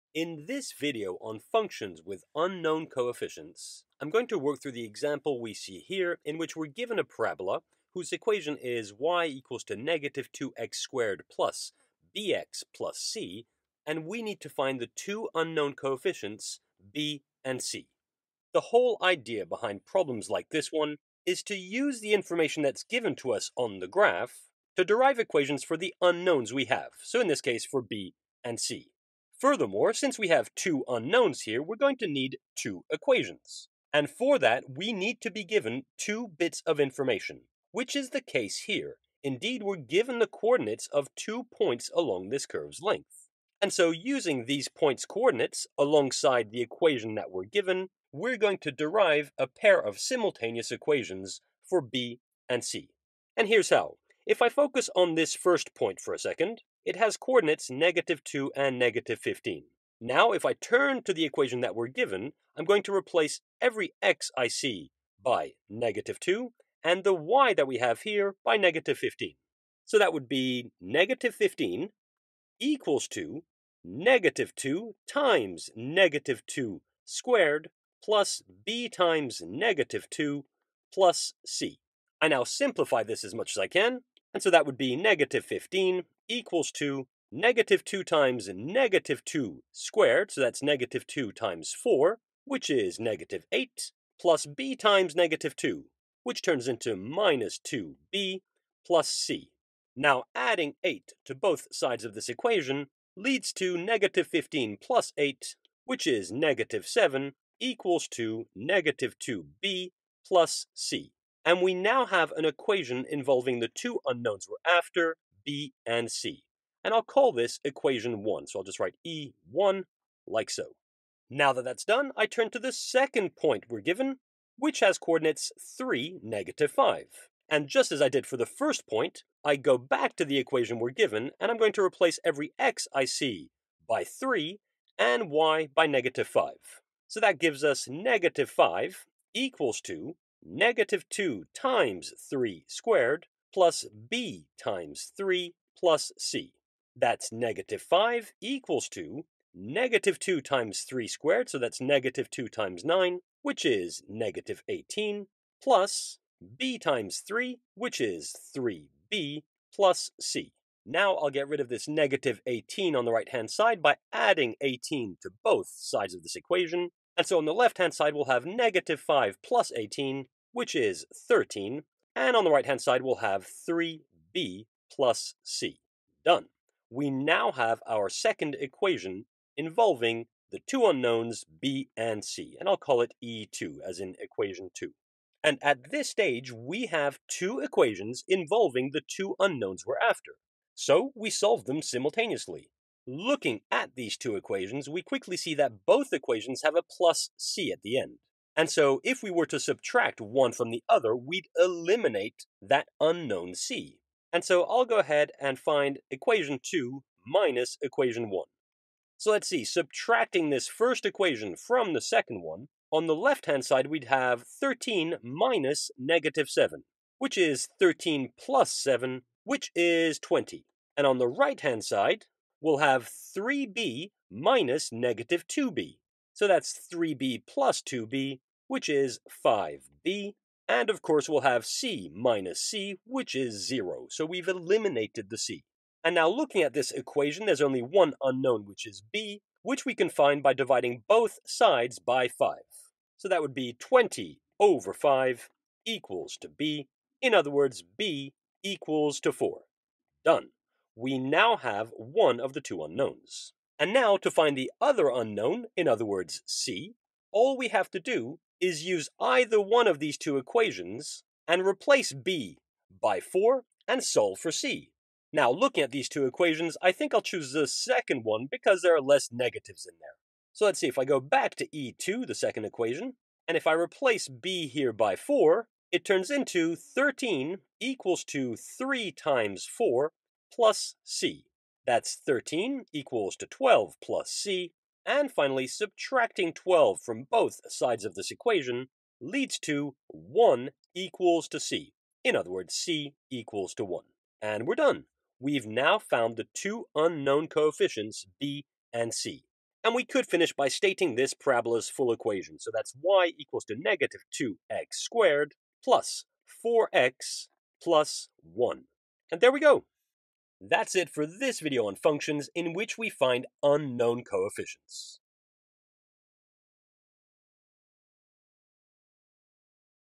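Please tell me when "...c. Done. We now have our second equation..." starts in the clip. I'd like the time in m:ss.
2:55.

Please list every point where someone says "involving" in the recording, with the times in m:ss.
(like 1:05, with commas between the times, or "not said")
1:53, 2:59, 3:08.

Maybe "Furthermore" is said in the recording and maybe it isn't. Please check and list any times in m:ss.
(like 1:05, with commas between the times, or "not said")
0:29.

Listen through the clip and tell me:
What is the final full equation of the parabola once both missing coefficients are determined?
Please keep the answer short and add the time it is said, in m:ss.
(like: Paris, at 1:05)
y = -2x² + 4x + 1, at 5:03.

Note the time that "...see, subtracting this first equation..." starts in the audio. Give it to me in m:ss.
3:29.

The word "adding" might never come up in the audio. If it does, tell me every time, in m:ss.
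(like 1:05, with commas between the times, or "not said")
1:40, 2:44.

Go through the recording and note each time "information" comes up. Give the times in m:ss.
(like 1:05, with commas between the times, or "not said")
0:22, 0:36.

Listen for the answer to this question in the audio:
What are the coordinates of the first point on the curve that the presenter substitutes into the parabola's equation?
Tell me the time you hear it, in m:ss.
0:57.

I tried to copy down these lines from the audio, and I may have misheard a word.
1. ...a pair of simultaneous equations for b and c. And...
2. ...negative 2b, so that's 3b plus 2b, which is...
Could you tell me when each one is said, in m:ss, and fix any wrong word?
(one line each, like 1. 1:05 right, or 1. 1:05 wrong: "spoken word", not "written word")
1. 0:49 right
2. 3:44 right.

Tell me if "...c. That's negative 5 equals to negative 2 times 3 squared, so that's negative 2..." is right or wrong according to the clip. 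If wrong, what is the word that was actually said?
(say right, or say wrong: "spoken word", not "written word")
right.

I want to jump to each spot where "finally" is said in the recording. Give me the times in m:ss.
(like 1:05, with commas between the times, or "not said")
4:45.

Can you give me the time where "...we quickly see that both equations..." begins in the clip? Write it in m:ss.
3:14.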